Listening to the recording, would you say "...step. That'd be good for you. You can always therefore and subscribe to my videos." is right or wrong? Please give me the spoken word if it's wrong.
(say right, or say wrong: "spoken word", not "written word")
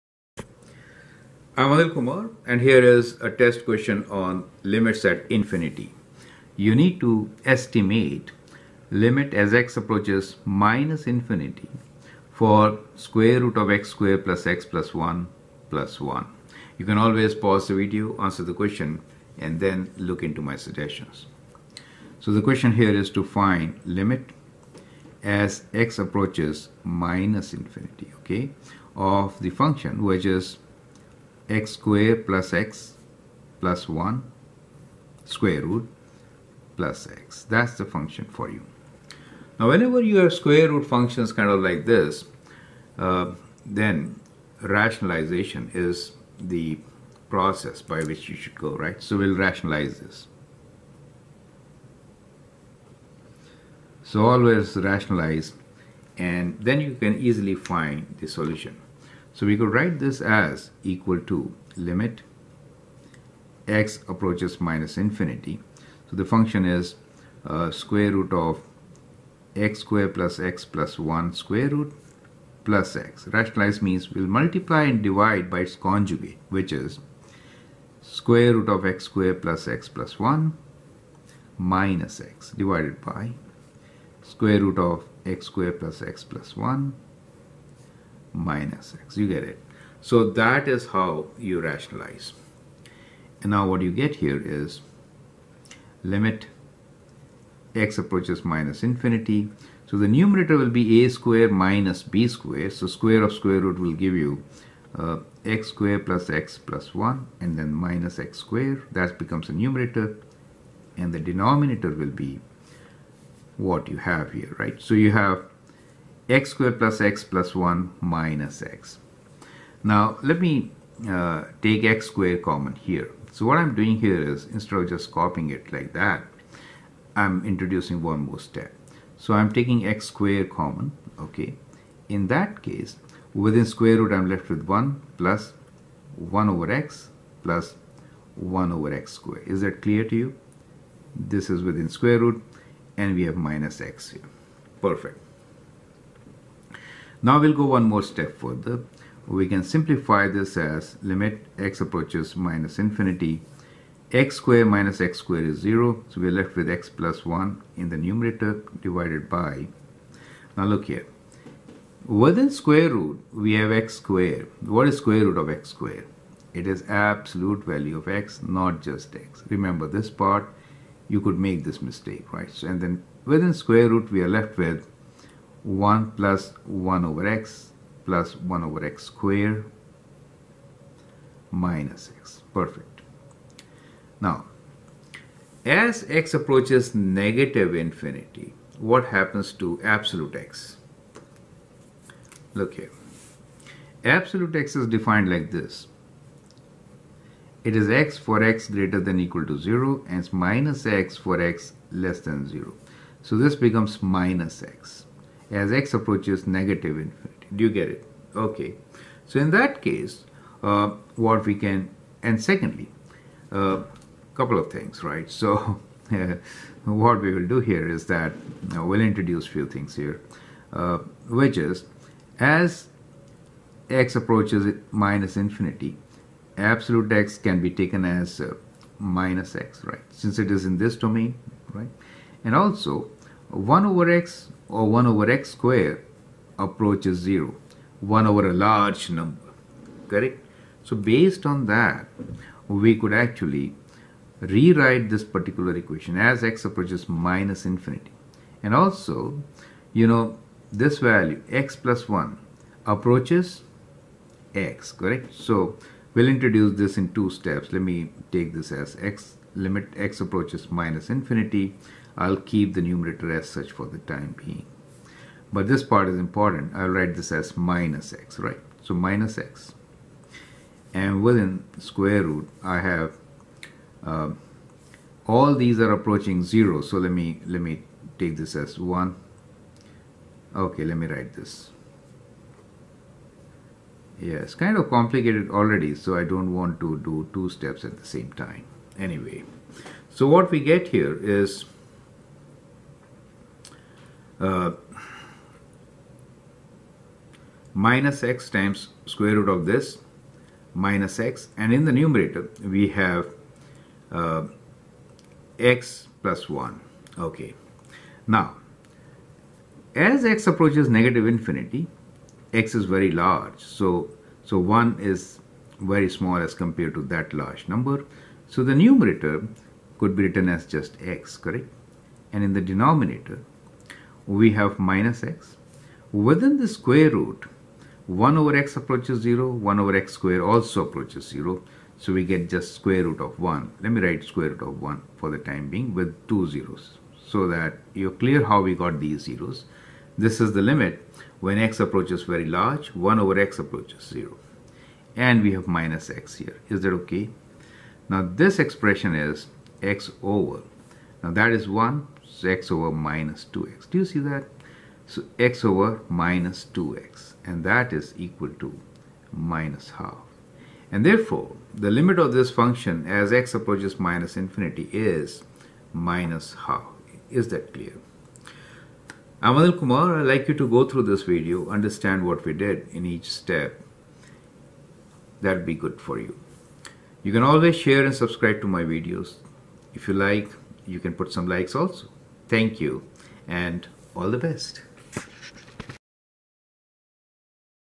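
wrong: "share", not "therefore".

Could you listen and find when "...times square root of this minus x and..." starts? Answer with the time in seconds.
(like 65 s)
298 s.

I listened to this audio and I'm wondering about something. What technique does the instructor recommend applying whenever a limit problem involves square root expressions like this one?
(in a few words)
Rationalization.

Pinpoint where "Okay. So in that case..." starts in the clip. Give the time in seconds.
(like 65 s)
208 s.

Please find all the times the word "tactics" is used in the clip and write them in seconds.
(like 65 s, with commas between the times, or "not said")
not said.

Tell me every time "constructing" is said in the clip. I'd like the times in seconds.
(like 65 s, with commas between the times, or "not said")
not said.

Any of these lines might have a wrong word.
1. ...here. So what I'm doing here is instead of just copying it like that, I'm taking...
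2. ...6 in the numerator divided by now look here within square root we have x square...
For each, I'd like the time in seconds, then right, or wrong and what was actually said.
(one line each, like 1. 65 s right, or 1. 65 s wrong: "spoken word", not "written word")
1. 122 s wrong: "introducing", not "taking"
2. 157 s wrong: "1", not "6".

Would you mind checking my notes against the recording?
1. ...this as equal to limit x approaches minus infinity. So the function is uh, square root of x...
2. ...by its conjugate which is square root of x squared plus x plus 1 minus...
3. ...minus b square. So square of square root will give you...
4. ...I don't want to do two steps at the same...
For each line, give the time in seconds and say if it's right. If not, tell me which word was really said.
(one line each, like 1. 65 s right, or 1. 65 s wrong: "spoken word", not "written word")
1. 59 s right
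2. 75 s right
3. 101 s right
4. 286 s right.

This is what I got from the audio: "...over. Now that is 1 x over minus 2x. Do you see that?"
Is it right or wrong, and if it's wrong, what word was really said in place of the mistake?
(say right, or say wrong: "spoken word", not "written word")
right.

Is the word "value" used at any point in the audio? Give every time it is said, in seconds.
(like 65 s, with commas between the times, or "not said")
167 s, 250 s.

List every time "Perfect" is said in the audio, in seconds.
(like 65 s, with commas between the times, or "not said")
144 s, 182 s.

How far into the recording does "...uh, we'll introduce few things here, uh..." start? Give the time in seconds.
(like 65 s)
218 s.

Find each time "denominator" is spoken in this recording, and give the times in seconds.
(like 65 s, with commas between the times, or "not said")
111 s, 322 s.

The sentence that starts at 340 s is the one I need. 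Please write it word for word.
This is the limit when x approaches very large, 1 over x approaches 0.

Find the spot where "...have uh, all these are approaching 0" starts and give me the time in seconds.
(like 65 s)
272 s.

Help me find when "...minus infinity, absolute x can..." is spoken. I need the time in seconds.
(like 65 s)
224 s.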